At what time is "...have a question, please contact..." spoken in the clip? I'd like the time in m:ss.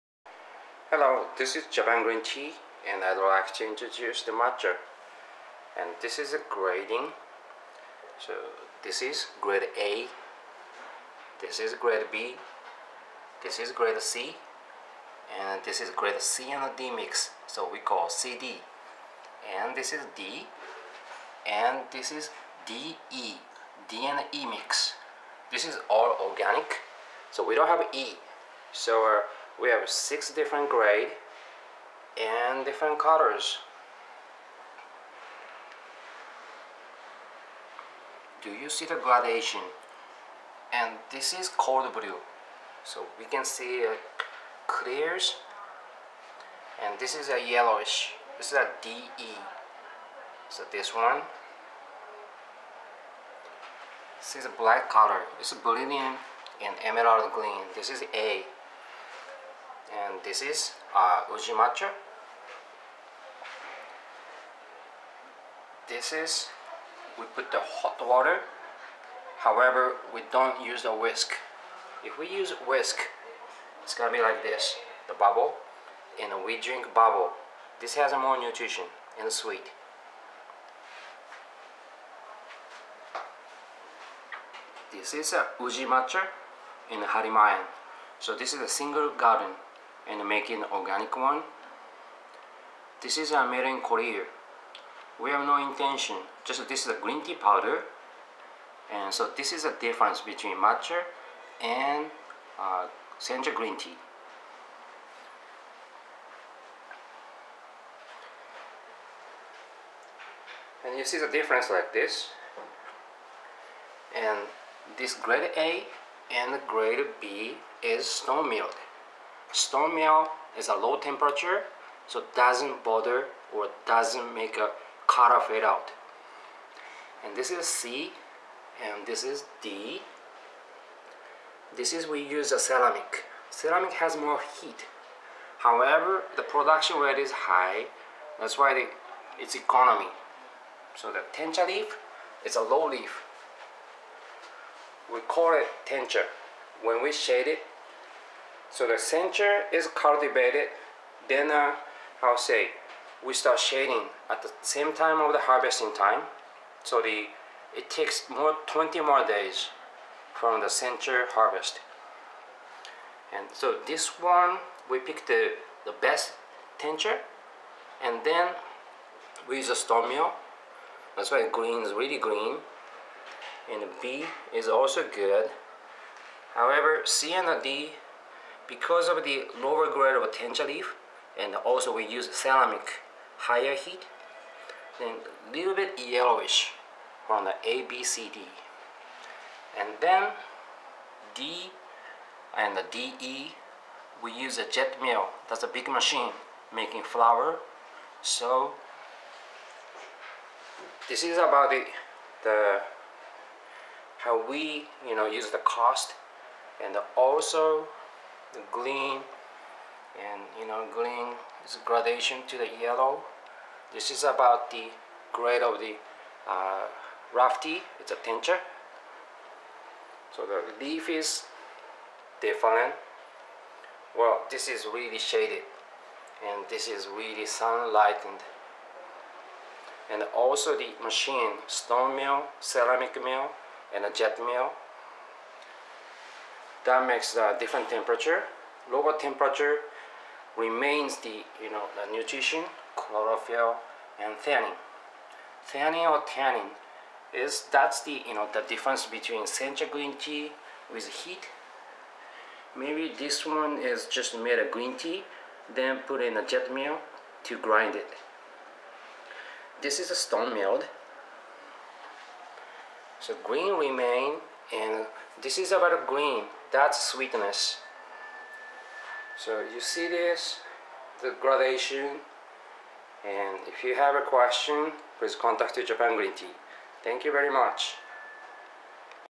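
4:33.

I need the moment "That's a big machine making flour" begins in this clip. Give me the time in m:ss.
3:15.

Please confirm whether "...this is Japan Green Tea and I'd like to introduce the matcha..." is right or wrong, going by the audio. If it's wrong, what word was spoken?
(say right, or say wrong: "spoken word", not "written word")
right.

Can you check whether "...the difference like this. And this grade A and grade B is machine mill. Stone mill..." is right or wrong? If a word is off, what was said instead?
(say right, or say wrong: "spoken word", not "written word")
wrong: "stone", not "machine".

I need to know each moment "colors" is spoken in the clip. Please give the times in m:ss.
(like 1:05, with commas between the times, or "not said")
0:32, 0:54.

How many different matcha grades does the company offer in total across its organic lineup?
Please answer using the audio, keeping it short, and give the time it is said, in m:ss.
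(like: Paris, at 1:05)
6, at 0:29.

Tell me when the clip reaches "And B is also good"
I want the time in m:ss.
2:53.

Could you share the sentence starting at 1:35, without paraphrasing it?
We have no intention, just this is a green tea powder.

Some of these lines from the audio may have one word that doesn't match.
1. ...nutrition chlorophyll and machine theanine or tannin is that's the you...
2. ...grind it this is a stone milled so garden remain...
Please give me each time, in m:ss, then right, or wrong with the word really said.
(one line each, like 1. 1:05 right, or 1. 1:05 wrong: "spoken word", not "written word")
1. 4:02 wrong: "theanine", not "machine"
2. 4:17 wrong: "green", not "garden".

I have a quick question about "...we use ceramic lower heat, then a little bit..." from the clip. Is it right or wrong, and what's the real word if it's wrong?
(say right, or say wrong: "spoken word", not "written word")
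wrong: "higher", not "lower".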